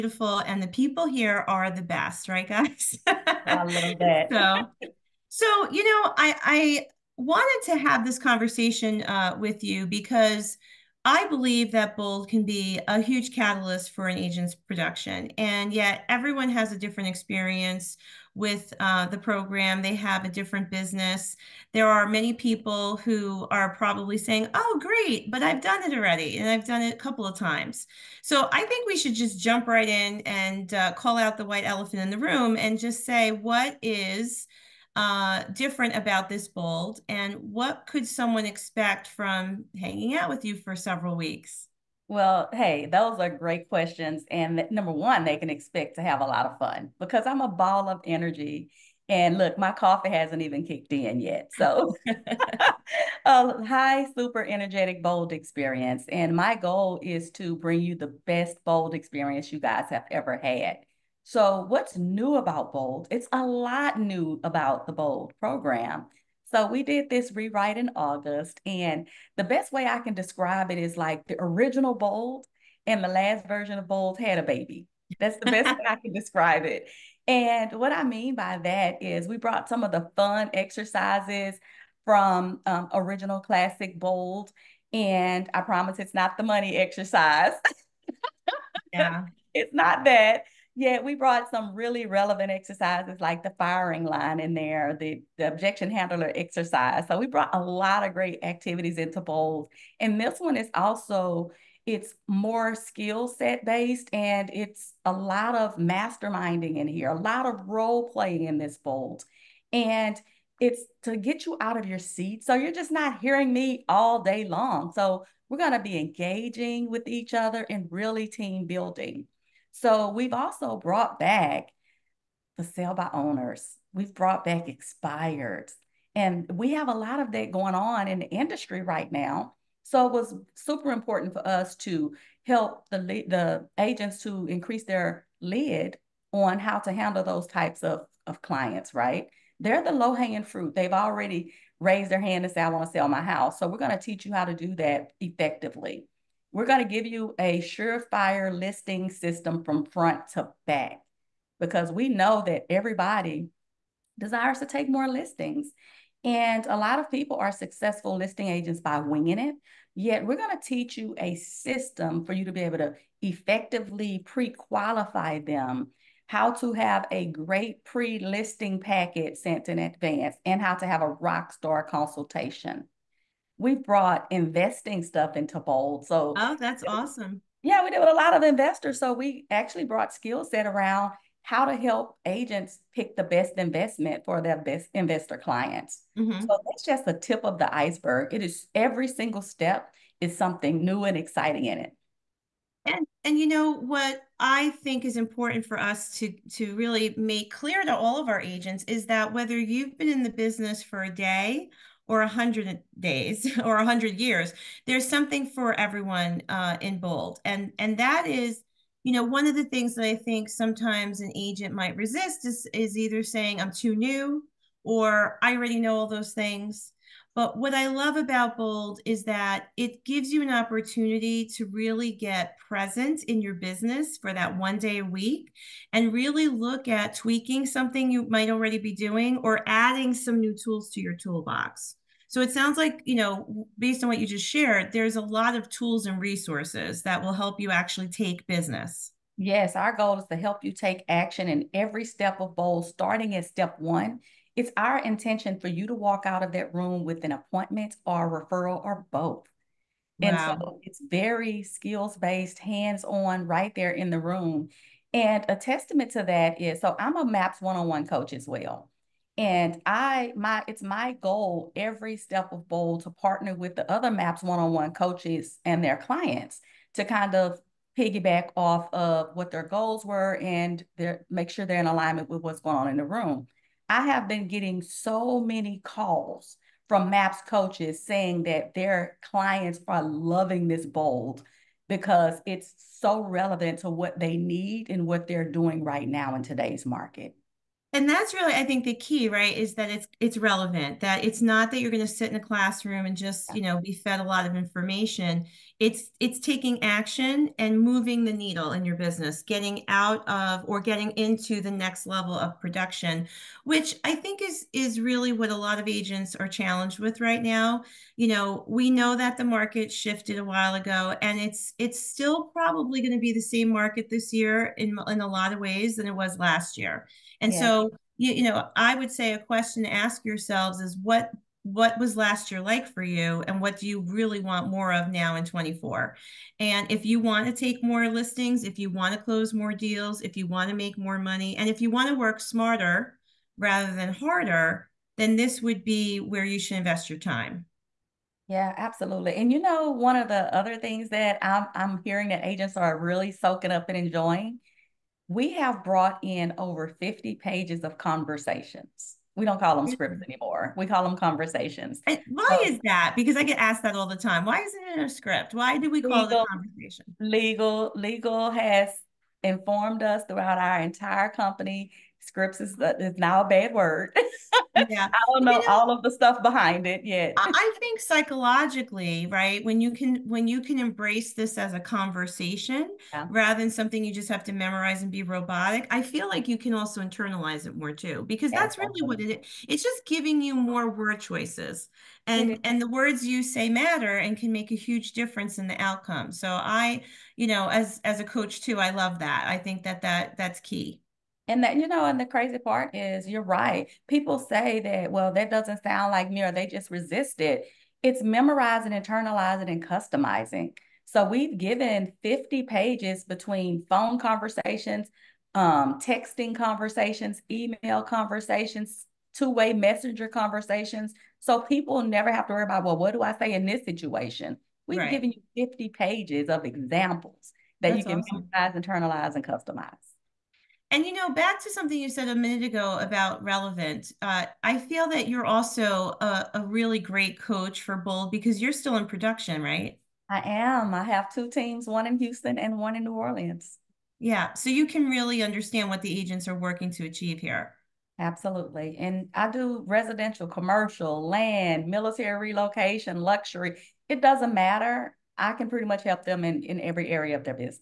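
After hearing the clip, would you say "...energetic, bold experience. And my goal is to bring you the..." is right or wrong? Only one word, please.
right.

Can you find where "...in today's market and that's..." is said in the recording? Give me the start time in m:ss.
4:46.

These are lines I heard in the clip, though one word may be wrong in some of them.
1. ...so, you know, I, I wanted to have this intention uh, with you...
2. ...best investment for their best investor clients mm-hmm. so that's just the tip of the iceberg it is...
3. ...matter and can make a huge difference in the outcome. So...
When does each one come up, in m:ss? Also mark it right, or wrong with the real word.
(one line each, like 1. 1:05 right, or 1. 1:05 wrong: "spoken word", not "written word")
1. 0:05 wrong: "conversation", not "intention"
2. 3:03 right
3. 6:23 right.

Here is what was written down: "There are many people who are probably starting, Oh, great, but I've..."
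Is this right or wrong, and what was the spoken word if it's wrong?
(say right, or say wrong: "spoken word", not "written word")
wrong: "saying", not "starting".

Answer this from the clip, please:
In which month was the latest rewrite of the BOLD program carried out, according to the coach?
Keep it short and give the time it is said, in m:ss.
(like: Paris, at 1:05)
August, at 1:07.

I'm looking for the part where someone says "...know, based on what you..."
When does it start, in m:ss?
3:53.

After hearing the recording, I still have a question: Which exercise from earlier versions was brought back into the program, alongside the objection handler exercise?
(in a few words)
The firing line.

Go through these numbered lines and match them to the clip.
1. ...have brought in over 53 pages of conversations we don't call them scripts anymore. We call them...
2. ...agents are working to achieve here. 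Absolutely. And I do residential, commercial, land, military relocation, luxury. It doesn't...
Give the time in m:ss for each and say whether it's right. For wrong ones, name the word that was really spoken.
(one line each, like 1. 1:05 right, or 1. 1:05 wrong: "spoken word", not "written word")
1. 5:45 wrong: "50", not "53"
2. 7:16 right.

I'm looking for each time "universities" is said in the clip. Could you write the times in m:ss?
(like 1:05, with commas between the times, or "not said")
not said.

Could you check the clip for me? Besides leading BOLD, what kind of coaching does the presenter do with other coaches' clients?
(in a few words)
MAPS one on one.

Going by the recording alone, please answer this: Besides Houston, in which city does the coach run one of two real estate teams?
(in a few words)
New Orleans.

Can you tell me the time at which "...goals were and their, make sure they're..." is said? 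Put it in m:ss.
4:29.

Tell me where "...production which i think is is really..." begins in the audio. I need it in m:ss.
5:02.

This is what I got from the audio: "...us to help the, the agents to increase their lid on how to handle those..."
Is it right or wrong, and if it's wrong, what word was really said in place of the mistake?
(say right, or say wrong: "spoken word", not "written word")
right.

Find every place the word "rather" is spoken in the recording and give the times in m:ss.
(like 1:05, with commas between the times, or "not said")
5:33, 6:13.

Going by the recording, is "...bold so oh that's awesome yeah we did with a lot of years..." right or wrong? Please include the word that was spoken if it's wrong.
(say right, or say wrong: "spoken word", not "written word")
wrong: "investors", not "years".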